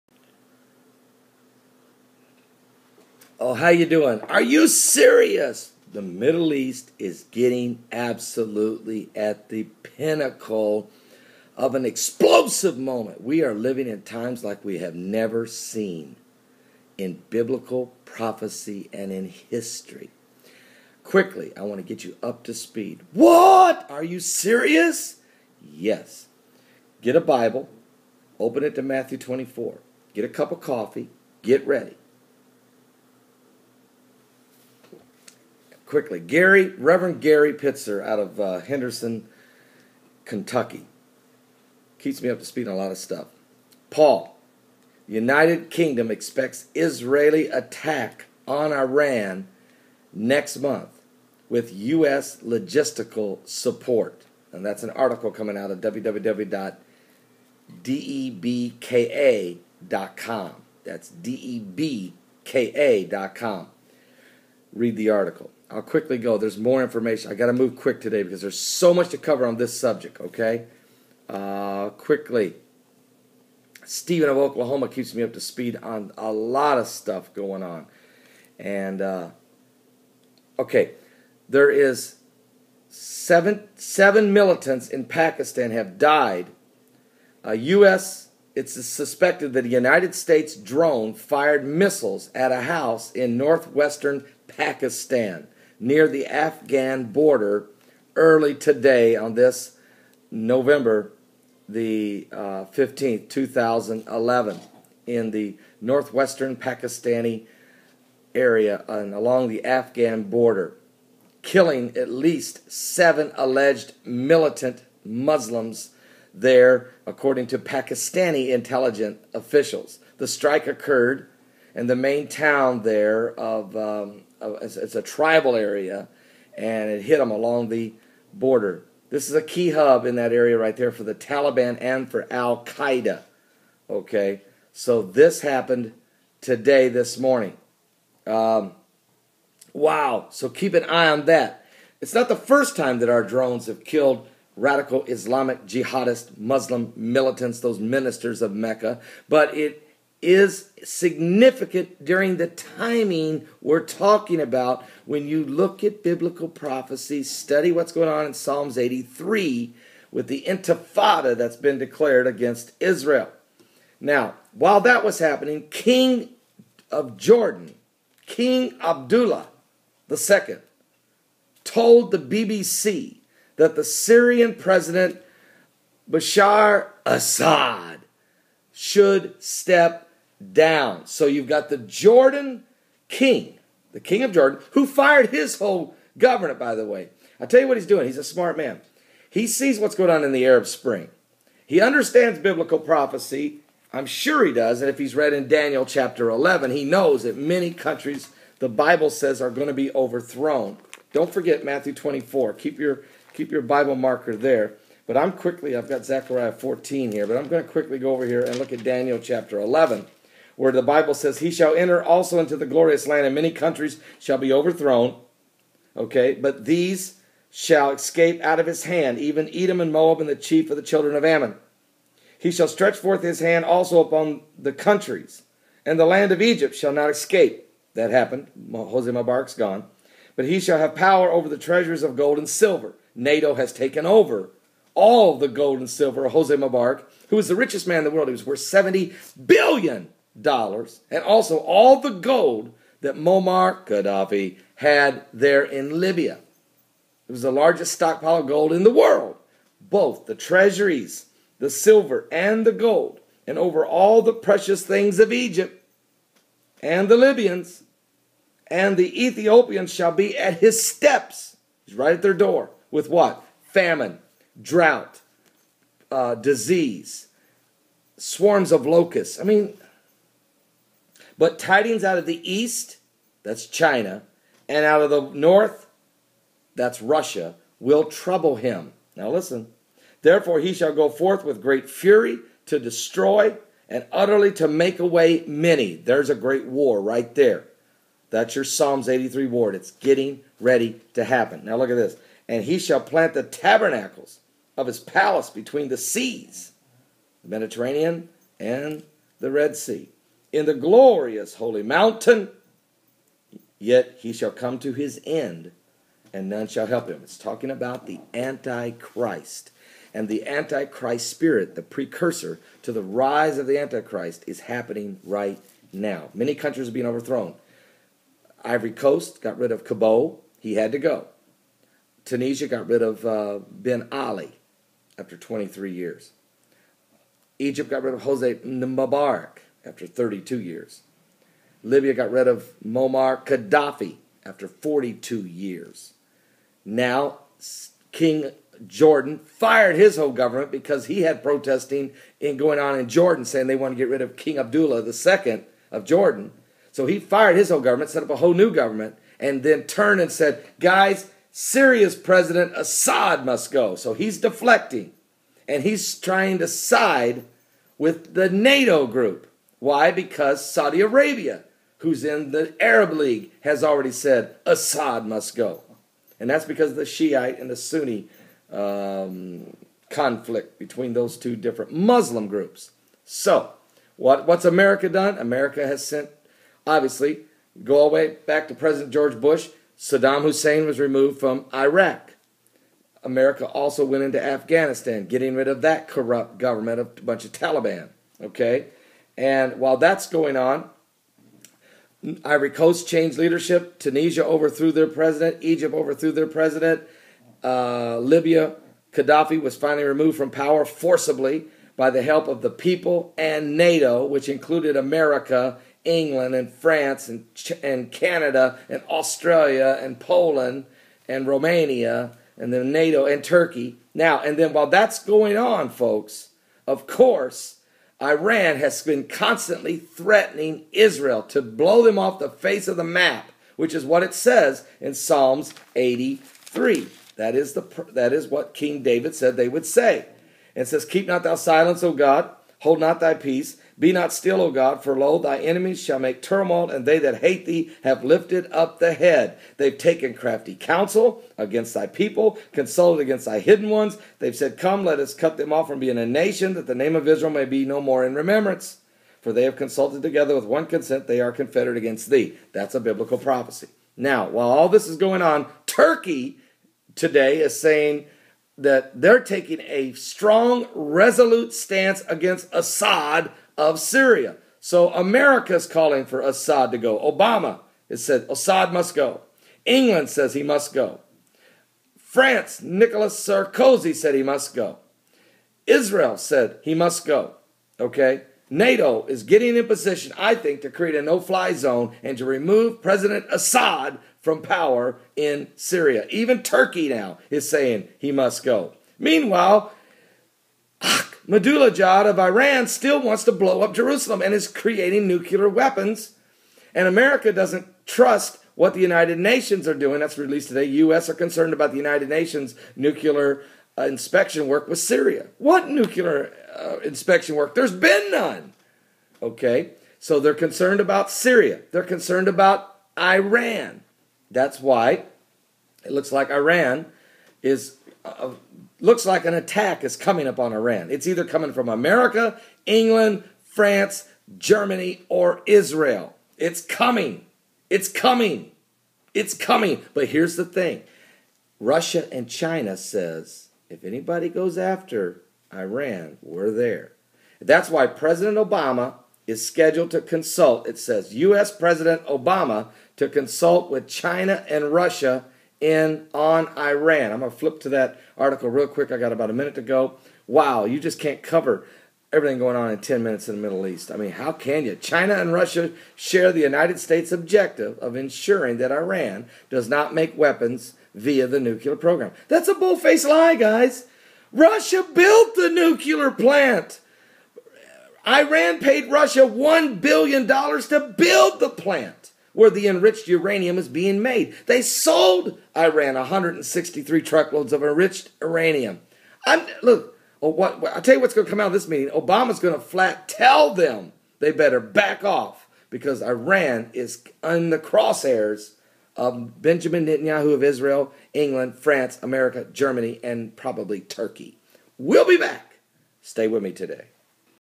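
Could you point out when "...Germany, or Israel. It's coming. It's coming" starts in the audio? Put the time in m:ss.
8:44.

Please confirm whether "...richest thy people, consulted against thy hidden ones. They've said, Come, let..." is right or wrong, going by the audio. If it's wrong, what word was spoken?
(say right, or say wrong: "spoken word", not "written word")
wrong: "against", not "richest".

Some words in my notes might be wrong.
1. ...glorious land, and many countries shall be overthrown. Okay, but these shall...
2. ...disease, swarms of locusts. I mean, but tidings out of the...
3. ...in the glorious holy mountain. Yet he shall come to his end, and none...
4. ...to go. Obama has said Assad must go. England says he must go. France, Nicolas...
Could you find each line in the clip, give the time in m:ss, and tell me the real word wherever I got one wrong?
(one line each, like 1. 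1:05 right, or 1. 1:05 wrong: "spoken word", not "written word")
1. 3:32 right
2. 4:26 right
3. 5:00 right
4. 7:46 right.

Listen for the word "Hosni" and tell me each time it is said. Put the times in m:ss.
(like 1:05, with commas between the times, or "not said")
3:48, 3:56, 5:28.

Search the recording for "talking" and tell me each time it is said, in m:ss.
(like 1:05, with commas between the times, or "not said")
2:33, 5:07.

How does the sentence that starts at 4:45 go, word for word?
There's a great war right there.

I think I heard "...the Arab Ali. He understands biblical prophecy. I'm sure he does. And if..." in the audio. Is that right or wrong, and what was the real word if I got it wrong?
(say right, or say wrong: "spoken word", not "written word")
wrong: "Spring", not "Ali".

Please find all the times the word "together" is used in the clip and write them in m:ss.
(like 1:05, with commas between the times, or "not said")
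7:30.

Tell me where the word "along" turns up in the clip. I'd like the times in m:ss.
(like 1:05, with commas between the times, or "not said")
1:49, 2:07.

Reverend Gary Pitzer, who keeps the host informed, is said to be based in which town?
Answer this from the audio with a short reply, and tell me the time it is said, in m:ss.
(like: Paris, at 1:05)
Henderson, Kentucky, at 0:38.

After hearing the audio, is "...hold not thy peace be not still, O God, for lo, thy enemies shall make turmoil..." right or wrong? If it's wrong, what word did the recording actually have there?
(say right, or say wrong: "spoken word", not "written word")
right.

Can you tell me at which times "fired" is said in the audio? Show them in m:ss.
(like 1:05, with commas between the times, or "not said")
1:31, 3:04, 5:39, 5:47.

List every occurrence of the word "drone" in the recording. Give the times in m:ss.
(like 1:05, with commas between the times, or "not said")
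1:30, 2:23.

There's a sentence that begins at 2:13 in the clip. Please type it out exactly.
Okay, so this happened today, this morning.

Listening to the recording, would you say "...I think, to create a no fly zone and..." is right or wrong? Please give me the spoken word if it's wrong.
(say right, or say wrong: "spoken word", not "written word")
right.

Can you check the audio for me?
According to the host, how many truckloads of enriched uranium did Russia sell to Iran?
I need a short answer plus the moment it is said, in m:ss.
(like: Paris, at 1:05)
163, at 9:36.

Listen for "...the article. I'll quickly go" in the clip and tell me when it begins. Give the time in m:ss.
1:04.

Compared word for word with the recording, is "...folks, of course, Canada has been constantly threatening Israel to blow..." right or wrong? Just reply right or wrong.
wrong.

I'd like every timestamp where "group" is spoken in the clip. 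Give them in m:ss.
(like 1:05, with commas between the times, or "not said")
5:59, 6:12.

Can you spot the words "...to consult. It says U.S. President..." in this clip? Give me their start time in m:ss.
9:00.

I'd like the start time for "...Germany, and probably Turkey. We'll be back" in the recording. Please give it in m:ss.
9:52.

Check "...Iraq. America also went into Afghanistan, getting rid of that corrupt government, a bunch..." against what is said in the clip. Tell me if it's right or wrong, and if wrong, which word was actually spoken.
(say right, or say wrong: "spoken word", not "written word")
right.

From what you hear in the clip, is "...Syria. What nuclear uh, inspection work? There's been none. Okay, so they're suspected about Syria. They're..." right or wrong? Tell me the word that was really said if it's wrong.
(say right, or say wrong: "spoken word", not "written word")
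wrong: "concerned", not "suspected".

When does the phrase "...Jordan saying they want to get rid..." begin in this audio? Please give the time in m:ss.
5:43.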